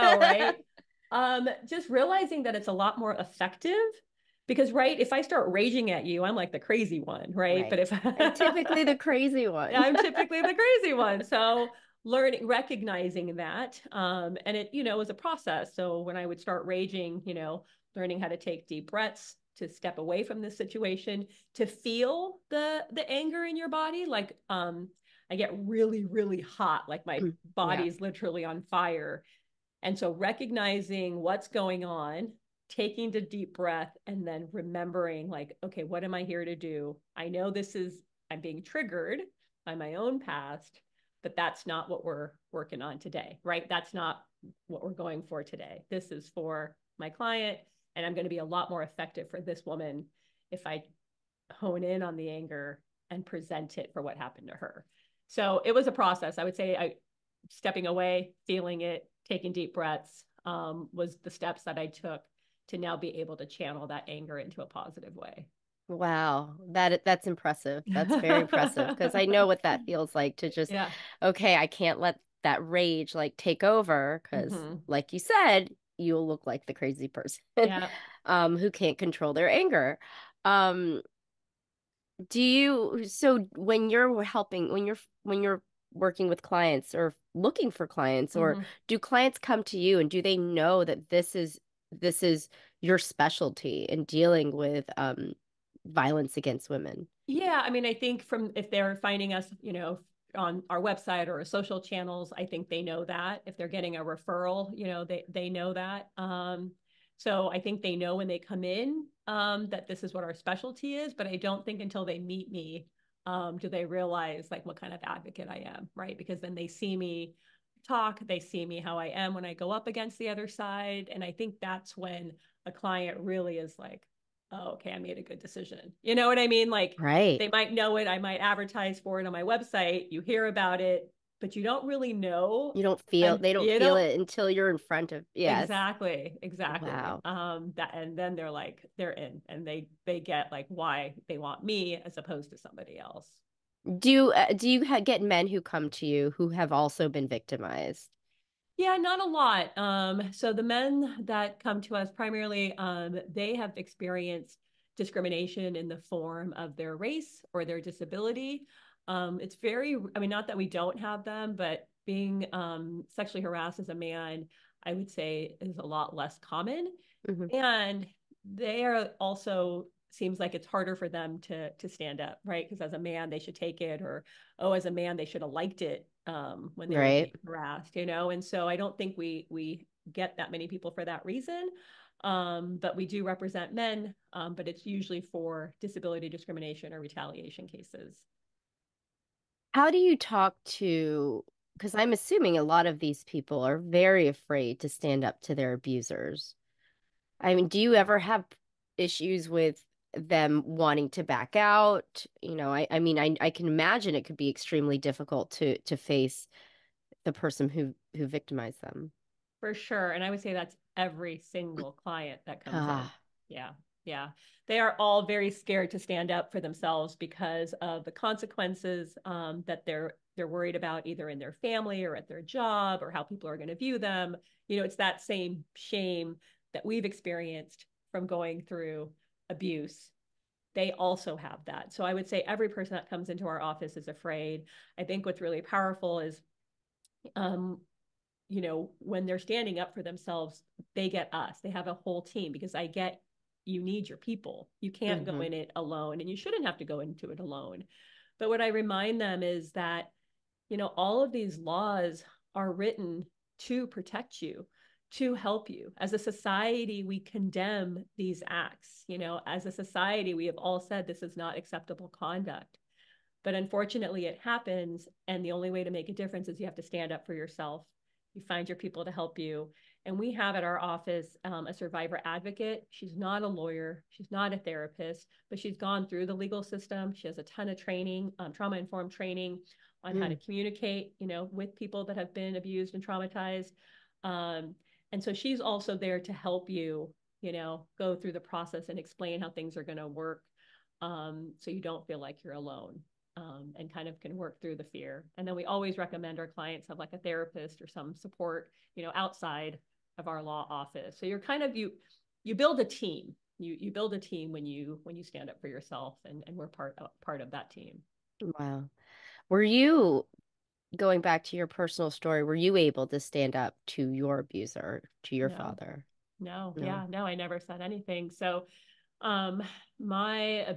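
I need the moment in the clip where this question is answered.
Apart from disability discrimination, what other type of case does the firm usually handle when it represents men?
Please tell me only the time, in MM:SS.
03:06.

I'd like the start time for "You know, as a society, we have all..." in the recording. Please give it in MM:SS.
04:19.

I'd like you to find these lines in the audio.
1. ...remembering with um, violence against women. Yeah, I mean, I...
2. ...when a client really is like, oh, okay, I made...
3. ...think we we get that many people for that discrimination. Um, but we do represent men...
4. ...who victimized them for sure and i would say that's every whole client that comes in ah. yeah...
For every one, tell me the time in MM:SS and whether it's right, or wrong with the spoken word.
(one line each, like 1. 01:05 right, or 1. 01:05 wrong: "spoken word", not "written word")
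1. 01:34 wrong: "dealing", not "remembering"
2. 02:01 right
3. 02:58 wrong: "reason", not "discrimination"
4. 03:28 wrong: "single", not "whole".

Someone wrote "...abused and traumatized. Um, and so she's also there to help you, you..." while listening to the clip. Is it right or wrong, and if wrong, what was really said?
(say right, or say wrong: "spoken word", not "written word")
right.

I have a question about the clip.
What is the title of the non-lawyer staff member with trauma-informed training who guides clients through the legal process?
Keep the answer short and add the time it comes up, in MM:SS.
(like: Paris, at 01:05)
Survivor advocate, at 04:31.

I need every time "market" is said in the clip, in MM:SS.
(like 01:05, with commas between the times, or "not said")
not said.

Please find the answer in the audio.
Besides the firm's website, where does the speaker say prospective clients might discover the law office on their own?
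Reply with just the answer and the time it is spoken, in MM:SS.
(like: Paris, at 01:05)
Social channels, at 01:41.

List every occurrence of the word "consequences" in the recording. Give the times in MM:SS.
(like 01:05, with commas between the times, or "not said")
03:38.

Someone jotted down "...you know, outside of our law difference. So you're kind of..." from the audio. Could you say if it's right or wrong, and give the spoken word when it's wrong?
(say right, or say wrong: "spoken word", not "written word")
wrong: "office", not "difference".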